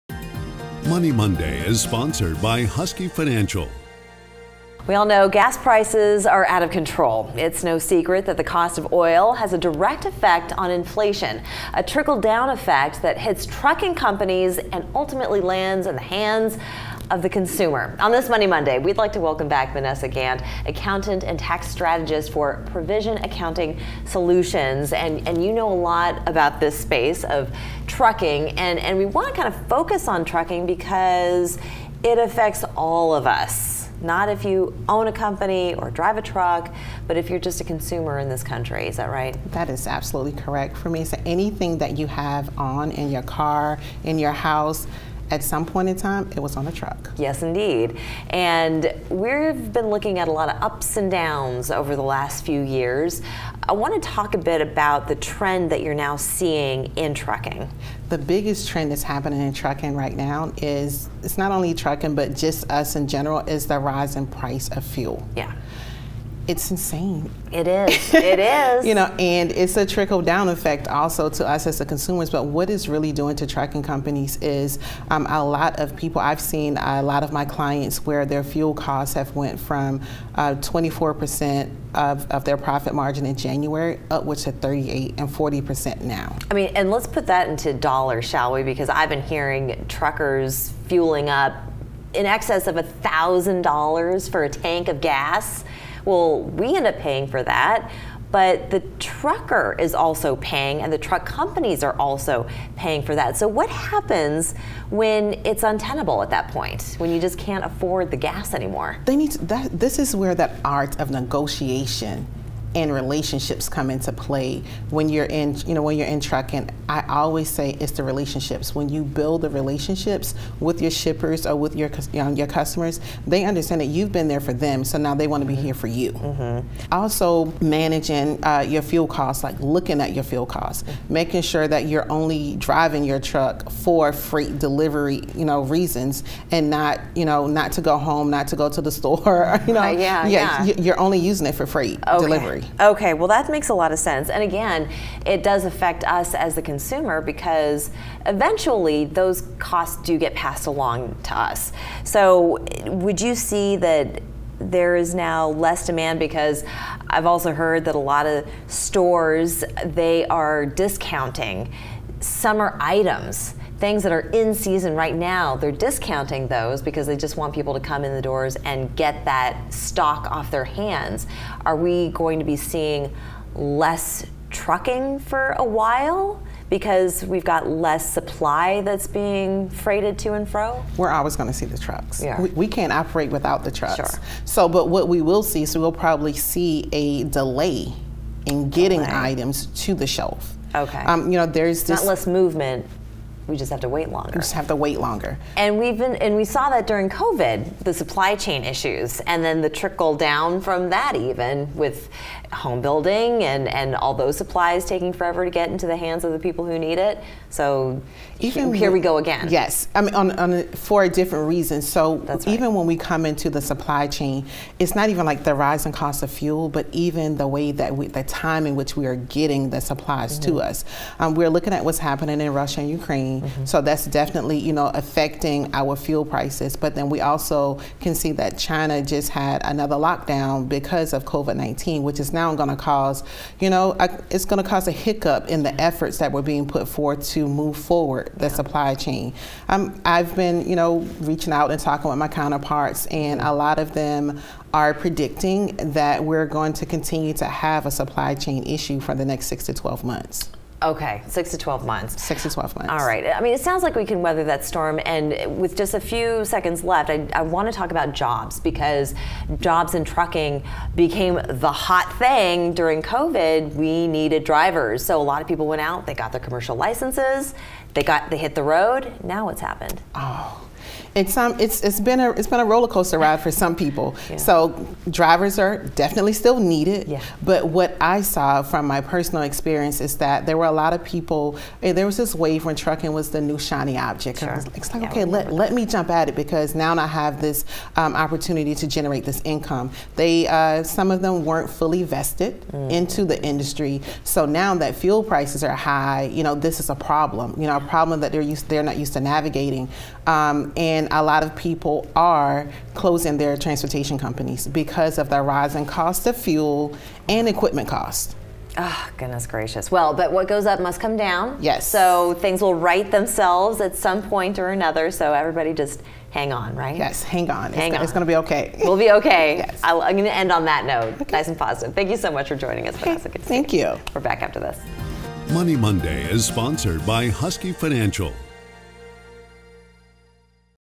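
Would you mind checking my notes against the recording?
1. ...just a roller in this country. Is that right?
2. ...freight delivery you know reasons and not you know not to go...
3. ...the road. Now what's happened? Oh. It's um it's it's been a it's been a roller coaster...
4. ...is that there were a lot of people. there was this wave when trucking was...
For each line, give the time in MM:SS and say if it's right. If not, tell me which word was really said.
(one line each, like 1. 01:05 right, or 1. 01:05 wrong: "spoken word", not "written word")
1. 00:37 wrong: "consumer", not "roller"
2. 02:14 right
3. 04:28 right
4. 04:40 right.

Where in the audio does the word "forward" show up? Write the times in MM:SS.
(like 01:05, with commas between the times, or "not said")
03:57.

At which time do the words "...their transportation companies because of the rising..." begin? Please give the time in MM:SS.
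05:03.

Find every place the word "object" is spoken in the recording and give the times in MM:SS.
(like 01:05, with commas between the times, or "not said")
04:43.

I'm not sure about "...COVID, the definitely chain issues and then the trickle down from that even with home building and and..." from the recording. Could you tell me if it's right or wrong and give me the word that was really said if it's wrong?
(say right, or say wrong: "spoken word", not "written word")
wrong: "supply", not "definitely".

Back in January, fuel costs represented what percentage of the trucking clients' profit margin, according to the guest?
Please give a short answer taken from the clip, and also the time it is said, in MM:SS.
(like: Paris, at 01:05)
24 percent, at 01:20.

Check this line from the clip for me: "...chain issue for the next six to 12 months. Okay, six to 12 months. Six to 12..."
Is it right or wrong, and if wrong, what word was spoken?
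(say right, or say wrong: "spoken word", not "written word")
right.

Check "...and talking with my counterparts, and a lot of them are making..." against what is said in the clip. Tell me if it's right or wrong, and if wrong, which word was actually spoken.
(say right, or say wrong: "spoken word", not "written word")
wrong: "predicting", not "making".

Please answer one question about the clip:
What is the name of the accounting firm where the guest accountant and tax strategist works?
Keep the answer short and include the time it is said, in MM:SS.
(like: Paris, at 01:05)
Provision Accounting Solutions, at 00:22.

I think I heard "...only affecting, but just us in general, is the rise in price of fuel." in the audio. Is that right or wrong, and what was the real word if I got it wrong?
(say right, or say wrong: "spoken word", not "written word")
wrong: "trucking", not "affecting".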